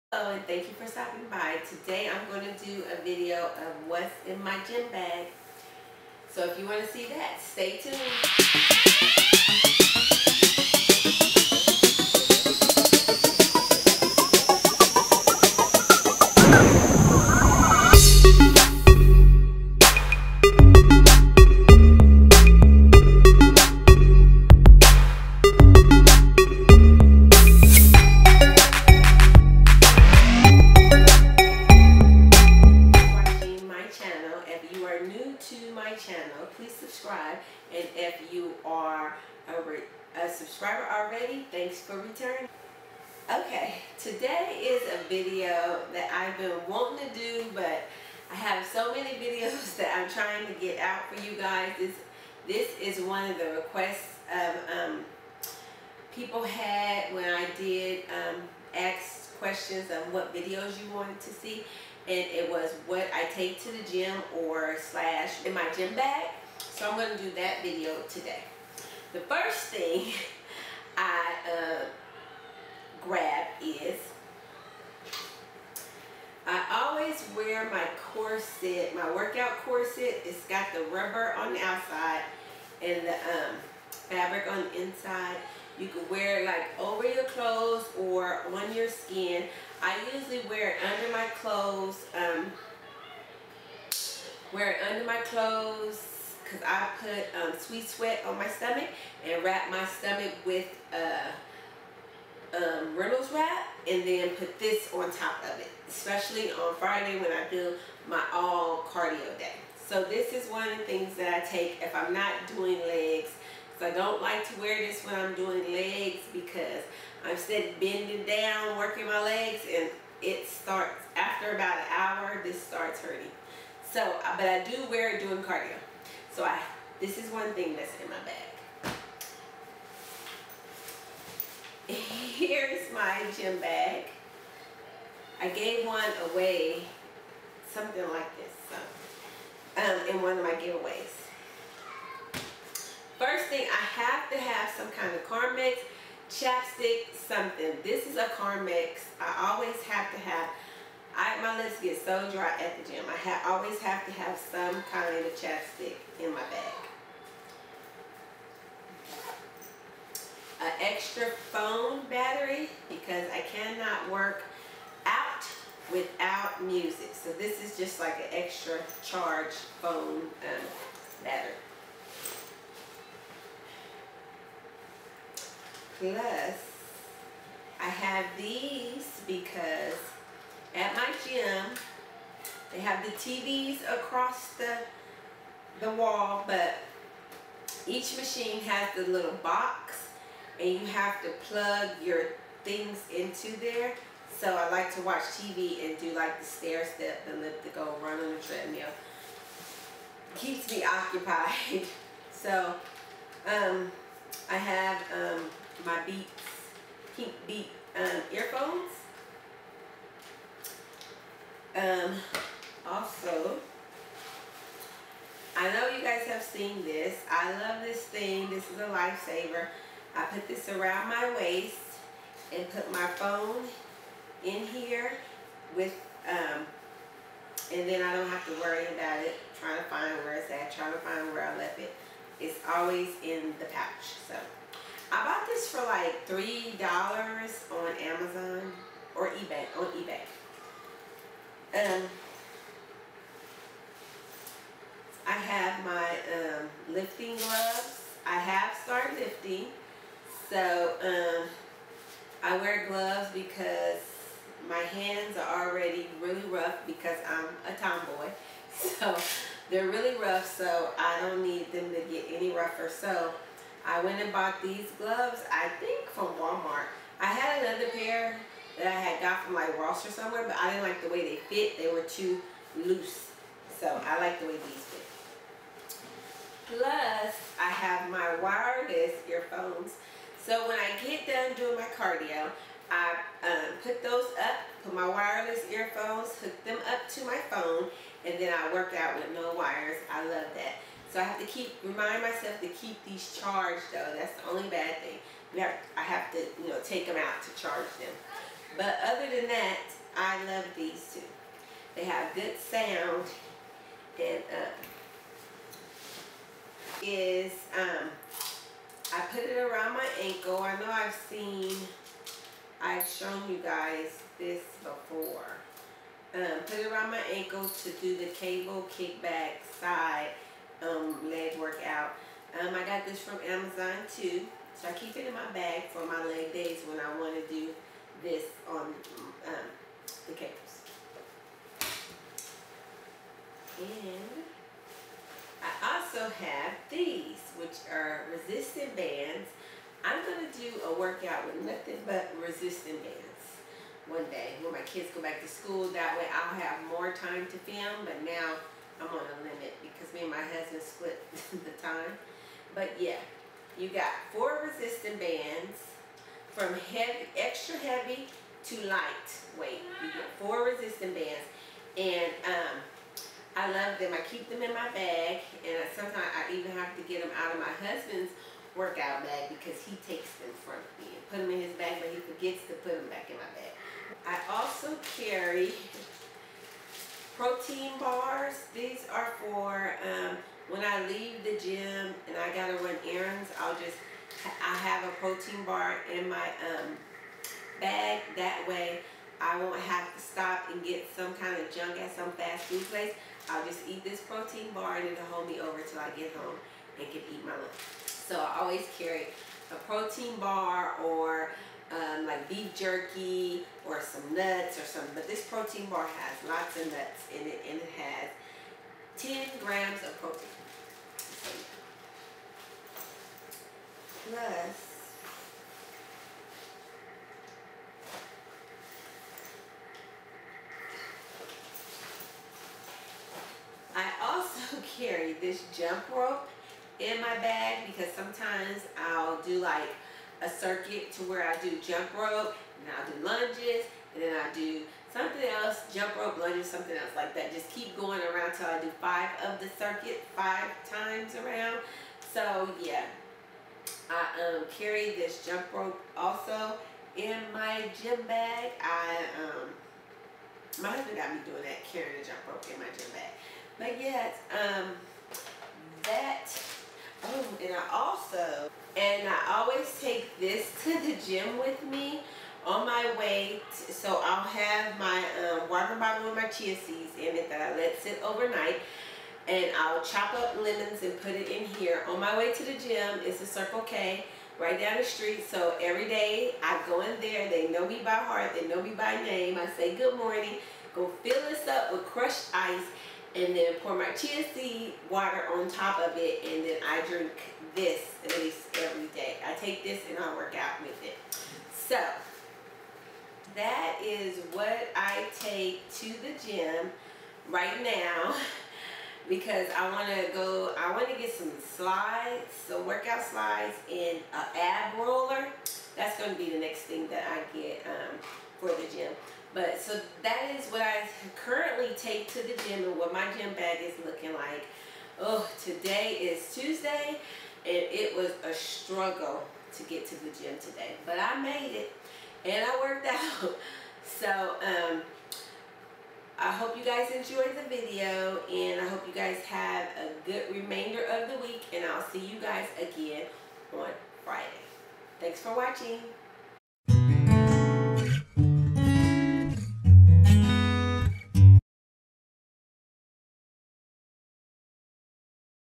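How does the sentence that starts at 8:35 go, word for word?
Oh, today is Tuesday and it was a struggle to get to the gym today.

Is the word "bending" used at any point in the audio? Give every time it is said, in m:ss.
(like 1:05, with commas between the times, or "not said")
1:57.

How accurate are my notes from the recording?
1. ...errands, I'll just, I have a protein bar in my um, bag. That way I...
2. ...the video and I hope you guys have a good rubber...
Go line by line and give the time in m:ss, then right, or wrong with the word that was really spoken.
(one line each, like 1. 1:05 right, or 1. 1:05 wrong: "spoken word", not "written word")
1. 6:23 right
2. 8:47 wrong: "remainder", not "rubber".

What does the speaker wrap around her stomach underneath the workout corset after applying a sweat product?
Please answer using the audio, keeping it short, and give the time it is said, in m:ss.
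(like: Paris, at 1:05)
Reynolds wrap, at 1:42.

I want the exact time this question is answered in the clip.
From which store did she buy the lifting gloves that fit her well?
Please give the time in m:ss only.
4:26.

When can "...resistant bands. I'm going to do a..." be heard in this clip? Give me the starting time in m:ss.
5:38.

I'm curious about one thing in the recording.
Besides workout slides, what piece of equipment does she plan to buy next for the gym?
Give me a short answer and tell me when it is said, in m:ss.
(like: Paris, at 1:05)
ab roller, at 8:24.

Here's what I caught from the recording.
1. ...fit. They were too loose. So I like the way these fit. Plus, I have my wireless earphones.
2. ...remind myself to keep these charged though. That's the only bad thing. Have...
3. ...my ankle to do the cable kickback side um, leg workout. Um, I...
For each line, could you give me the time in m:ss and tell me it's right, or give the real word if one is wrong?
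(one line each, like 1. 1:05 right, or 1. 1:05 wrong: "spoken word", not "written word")
1. 4:31 right
2. 4:51 right
3. 5:17 right.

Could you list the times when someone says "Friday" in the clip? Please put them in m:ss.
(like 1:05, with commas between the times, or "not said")
1:46, 8:54.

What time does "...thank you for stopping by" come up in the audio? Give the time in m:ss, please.
0:00.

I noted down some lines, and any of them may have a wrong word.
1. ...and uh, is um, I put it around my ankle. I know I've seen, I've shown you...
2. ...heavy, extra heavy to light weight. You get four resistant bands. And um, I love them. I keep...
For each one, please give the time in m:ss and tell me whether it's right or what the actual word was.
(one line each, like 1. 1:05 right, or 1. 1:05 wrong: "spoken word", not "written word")
1. 5:04 right
2. 5:56 right.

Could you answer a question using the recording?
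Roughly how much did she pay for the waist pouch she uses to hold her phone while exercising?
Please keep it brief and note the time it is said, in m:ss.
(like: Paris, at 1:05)
$3, at 3:56.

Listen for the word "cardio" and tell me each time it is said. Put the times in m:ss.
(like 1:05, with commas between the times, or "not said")
1:48, 2:05, 4:41.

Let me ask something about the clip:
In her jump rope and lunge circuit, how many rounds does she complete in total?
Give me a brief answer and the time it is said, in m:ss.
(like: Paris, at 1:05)
5, at 7:20.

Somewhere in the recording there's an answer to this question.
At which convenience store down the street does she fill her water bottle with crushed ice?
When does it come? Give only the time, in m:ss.
7:53.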